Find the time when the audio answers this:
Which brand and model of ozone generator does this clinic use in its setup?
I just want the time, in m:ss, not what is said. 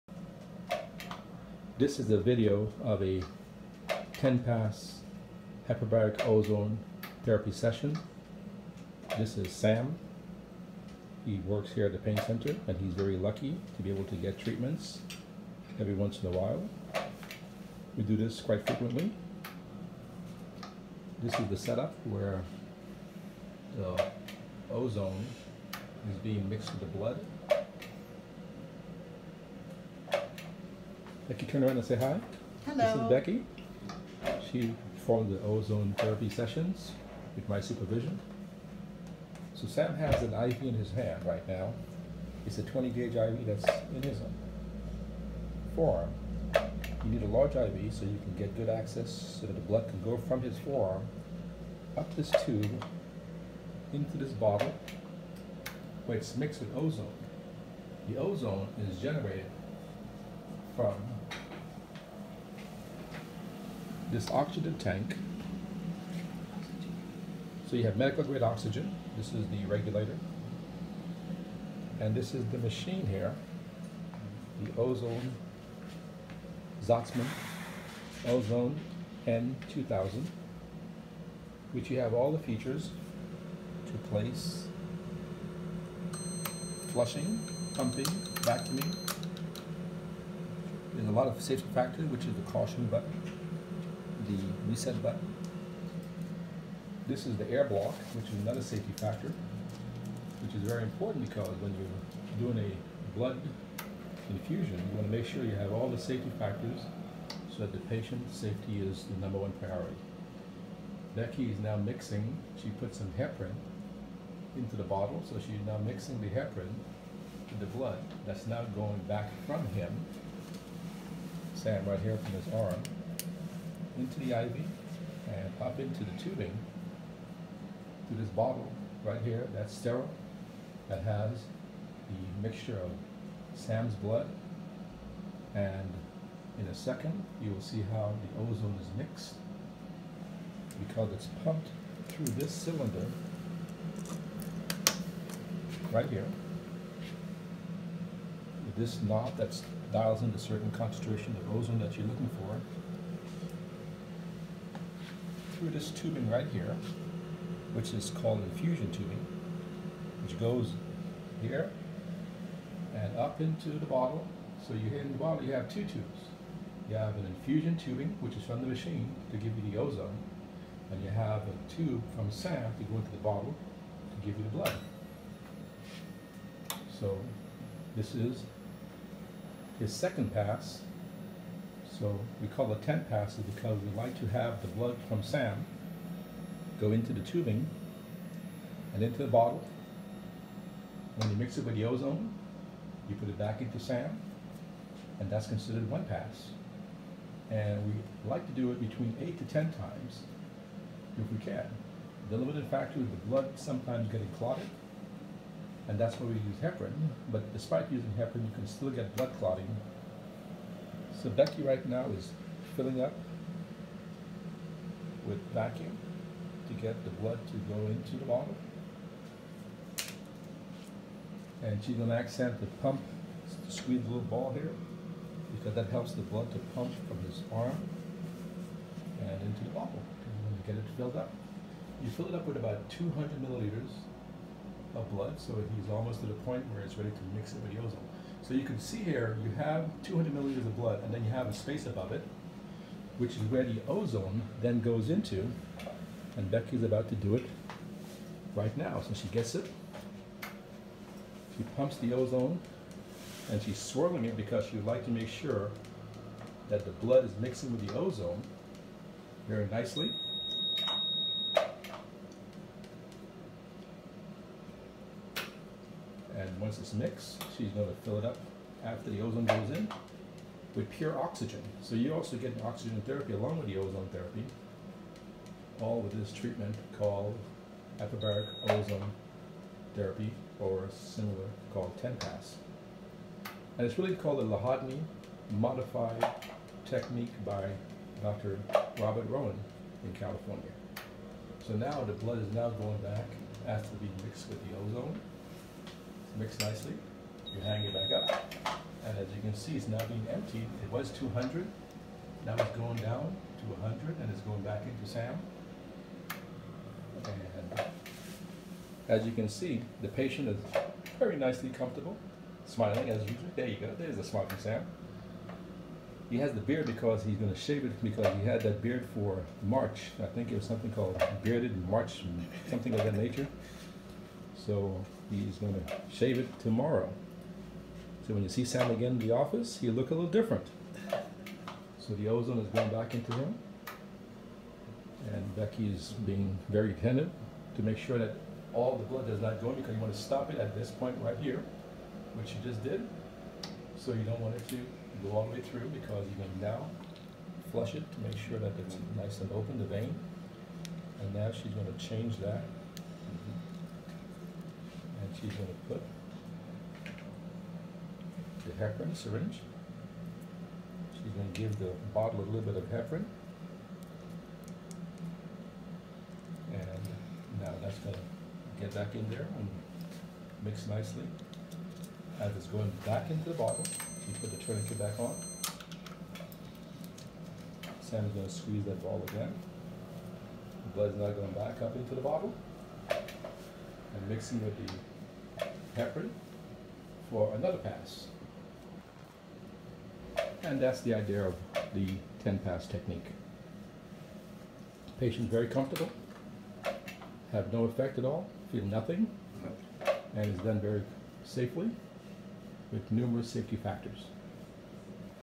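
1:16.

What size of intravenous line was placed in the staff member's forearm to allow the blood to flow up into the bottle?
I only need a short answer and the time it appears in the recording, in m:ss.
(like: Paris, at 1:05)
20 gauge, at 0:42.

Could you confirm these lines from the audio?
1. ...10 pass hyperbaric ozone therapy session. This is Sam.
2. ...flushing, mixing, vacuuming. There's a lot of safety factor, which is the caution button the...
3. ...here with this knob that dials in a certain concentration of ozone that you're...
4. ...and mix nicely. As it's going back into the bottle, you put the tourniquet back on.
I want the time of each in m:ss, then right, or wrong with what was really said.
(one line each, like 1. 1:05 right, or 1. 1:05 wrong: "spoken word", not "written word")
1. 0:04 right
2. 1:26 wrong: "pumping", not "mixing"
3. 2:26 right
4. 6:09 right.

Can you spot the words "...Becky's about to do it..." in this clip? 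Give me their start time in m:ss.
4:06.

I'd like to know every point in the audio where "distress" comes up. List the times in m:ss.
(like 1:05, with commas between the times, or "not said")
not said.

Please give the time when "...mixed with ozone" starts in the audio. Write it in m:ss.
0:56.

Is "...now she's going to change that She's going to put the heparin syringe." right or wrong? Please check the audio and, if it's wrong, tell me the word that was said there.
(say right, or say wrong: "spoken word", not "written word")
right.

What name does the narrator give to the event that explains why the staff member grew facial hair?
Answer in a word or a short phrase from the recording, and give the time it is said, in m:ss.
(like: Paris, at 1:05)
bearded March, at 5:21.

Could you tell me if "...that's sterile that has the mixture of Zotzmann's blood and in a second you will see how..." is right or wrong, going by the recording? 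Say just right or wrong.
wrong.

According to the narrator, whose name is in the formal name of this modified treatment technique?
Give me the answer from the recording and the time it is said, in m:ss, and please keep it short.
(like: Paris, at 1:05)
Lahodny, at 4:44.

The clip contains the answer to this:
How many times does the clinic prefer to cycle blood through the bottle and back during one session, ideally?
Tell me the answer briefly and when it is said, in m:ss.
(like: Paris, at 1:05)
8 to 10, at 3:19.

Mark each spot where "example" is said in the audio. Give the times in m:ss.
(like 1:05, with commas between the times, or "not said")
not said.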